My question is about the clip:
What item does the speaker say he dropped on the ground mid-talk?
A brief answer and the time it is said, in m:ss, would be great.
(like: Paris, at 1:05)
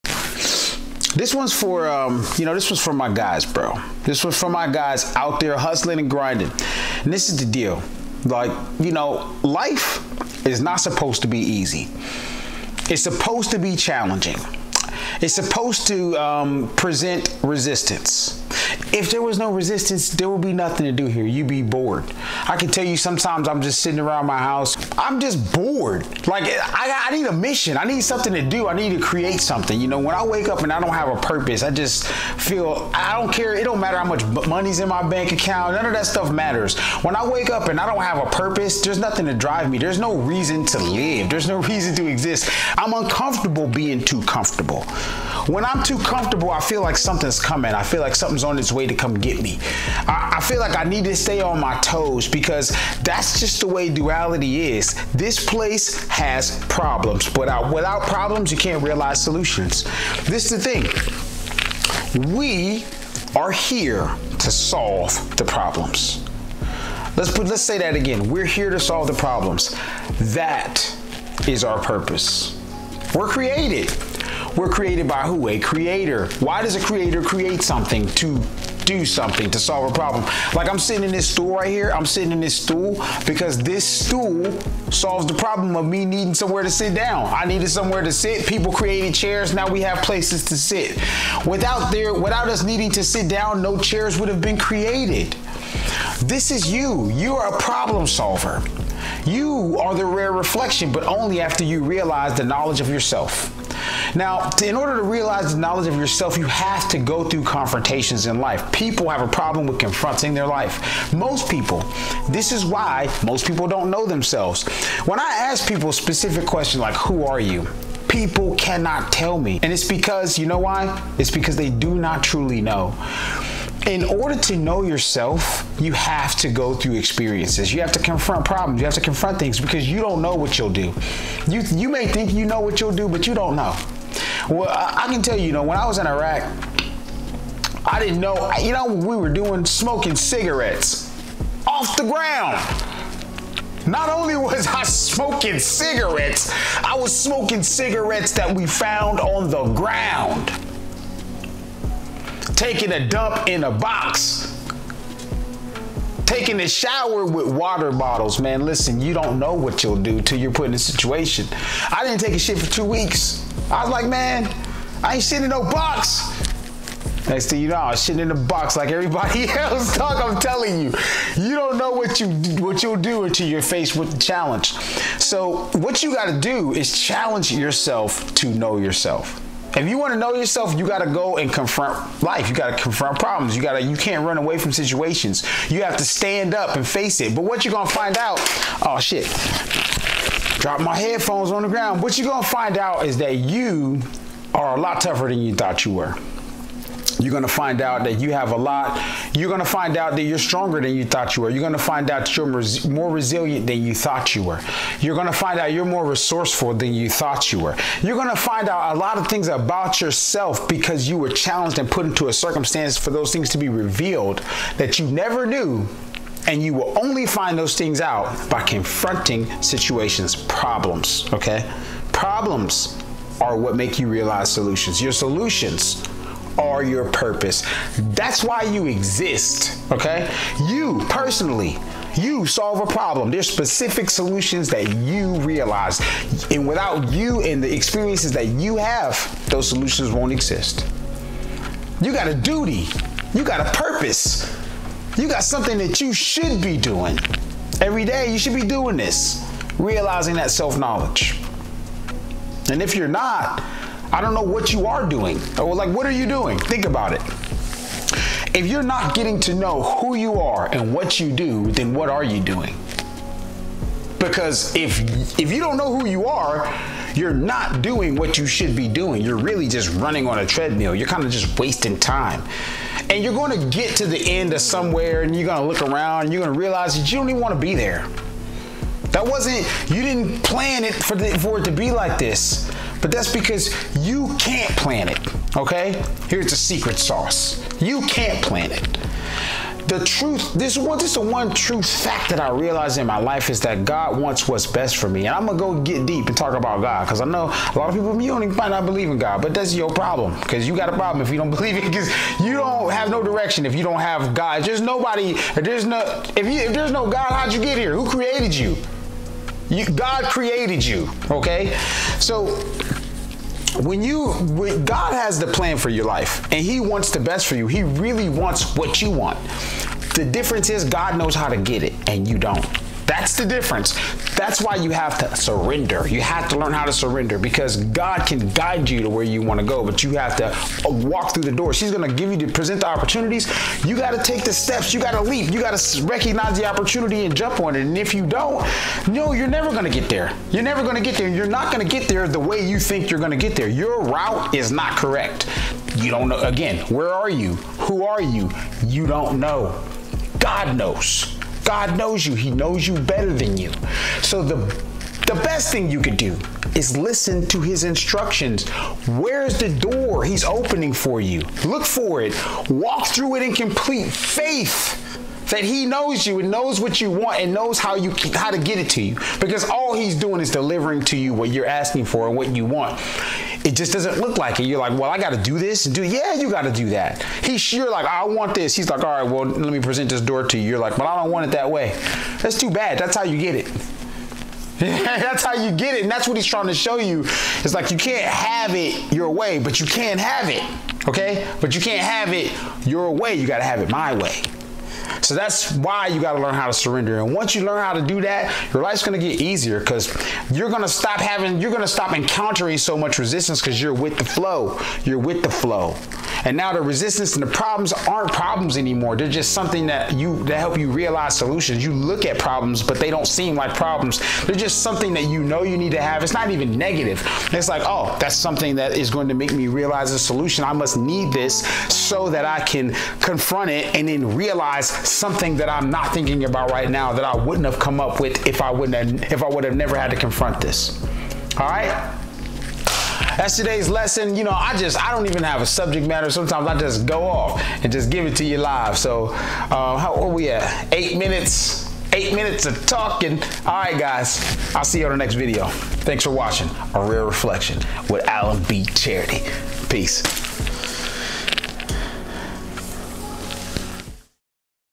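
headphones, at 3:10.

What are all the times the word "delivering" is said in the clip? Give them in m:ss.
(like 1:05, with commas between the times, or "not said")
6:10.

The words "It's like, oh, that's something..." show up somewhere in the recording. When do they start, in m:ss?
6:57.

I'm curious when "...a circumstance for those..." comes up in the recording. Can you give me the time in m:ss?
3:32.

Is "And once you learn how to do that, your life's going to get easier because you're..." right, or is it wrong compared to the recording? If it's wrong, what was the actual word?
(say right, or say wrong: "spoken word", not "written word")
right.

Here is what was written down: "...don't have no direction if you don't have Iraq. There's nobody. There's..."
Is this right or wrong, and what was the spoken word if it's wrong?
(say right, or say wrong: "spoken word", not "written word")
wrong: "God", not "Iraq".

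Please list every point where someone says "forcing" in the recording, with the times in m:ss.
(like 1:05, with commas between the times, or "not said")
not said.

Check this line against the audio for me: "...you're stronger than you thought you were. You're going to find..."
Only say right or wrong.
right.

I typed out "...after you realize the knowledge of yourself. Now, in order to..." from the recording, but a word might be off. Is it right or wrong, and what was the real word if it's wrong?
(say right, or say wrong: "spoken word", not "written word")
right.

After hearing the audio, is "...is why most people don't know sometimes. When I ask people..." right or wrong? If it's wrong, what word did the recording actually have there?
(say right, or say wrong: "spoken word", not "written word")
wrong: "themselves", not "sometimes".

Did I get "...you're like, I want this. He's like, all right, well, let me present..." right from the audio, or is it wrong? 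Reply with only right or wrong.
right.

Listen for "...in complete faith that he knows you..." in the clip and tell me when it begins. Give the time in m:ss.
6:03.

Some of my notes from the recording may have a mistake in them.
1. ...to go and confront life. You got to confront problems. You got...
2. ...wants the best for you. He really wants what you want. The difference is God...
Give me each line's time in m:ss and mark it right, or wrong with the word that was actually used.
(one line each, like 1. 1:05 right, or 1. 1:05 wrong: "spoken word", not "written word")
1. 3:01 right
2. 5:16 right.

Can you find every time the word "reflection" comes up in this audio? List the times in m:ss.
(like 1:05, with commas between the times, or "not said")
1:40, 7:27.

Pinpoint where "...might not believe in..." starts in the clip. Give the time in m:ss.
4:58.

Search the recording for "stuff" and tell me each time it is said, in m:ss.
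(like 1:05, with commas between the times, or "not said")
0:36.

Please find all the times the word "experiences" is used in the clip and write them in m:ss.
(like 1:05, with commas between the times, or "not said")
2:06, 3:57.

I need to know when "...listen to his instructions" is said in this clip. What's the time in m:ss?
5:56.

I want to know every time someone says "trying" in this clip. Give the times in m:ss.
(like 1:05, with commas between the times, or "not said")
6:26.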